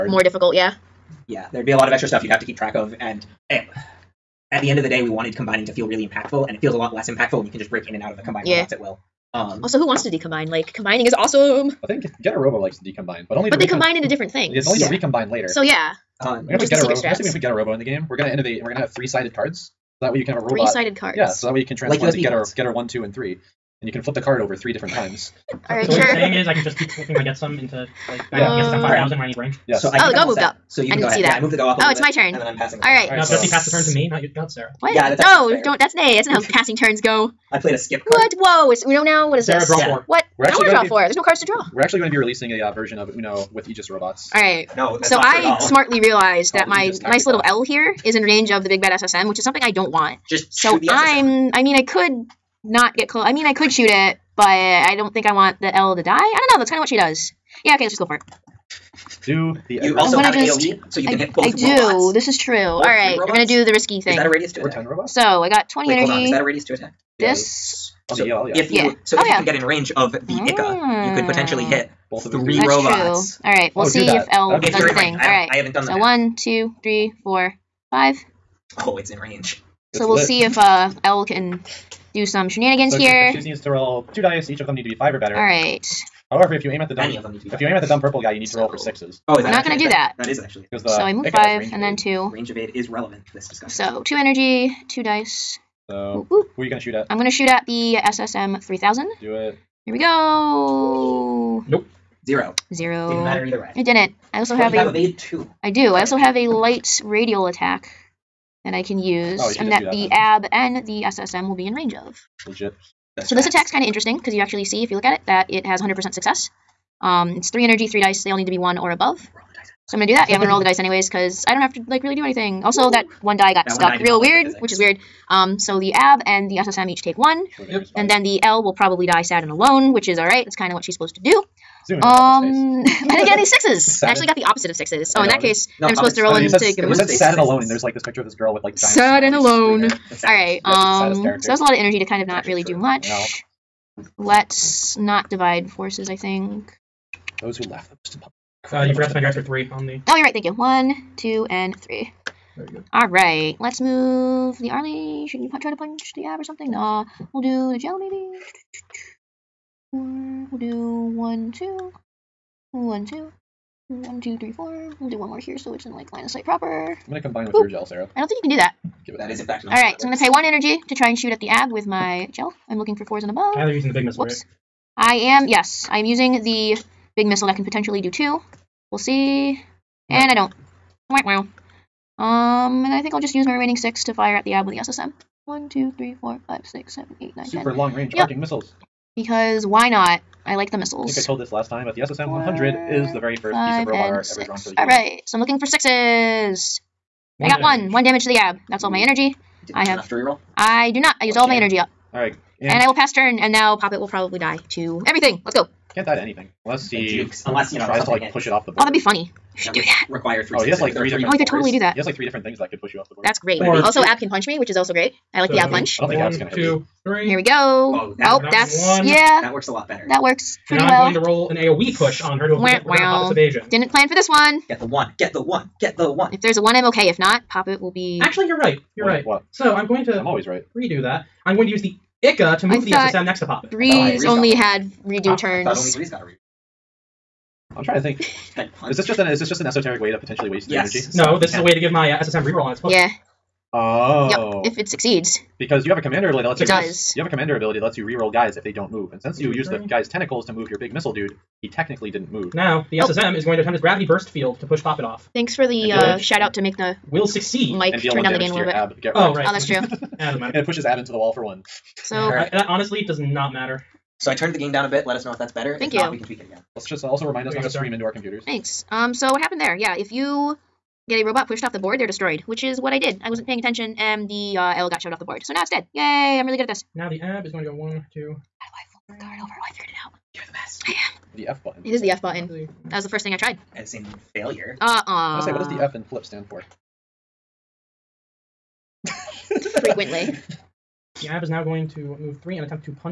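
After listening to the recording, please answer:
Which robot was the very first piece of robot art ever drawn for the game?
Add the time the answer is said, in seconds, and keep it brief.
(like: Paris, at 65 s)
SSM 100, at 192 s.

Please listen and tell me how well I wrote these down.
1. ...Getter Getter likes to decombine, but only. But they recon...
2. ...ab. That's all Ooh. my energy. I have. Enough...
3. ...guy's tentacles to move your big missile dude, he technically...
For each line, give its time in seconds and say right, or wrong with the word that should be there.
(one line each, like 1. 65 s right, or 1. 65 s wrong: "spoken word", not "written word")
1. 12 s wrong: "Robo", not "Getter"
2. 198 s right
3. 249 s right.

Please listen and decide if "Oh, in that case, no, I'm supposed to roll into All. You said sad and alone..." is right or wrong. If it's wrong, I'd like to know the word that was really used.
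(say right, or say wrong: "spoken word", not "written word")
wrong: "Gamoon", not "All".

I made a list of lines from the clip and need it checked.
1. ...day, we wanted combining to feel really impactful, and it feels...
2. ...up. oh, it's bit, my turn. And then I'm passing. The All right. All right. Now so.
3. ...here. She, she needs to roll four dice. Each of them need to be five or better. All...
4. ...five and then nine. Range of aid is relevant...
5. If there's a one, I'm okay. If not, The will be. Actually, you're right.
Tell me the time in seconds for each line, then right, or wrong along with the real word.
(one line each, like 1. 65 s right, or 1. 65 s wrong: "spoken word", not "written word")
1. 4 s right
2. 31 s right
3. 82 s wrong: "two", not "four"
4. 91 s wrong: "two", not "nine"
5. 226 s wrong: "Poppet", not "The".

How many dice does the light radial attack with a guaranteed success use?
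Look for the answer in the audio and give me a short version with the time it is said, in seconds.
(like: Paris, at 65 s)
3, at 117 s.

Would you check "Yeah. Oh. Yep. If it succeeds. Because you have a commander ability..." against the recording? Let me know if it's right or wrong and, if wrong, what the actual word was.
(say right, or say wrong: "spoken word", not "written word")
right.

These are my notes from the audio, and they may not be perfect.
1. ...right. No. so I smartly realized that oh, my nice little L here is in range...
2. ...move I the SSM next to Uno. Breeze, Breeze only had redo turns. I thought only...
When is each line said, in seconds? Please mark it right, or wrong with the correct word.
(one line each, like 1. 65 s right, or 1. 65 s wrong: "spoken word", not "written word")
1. 44 s right
2. 232 s wrong: "Poppet", not "Uno".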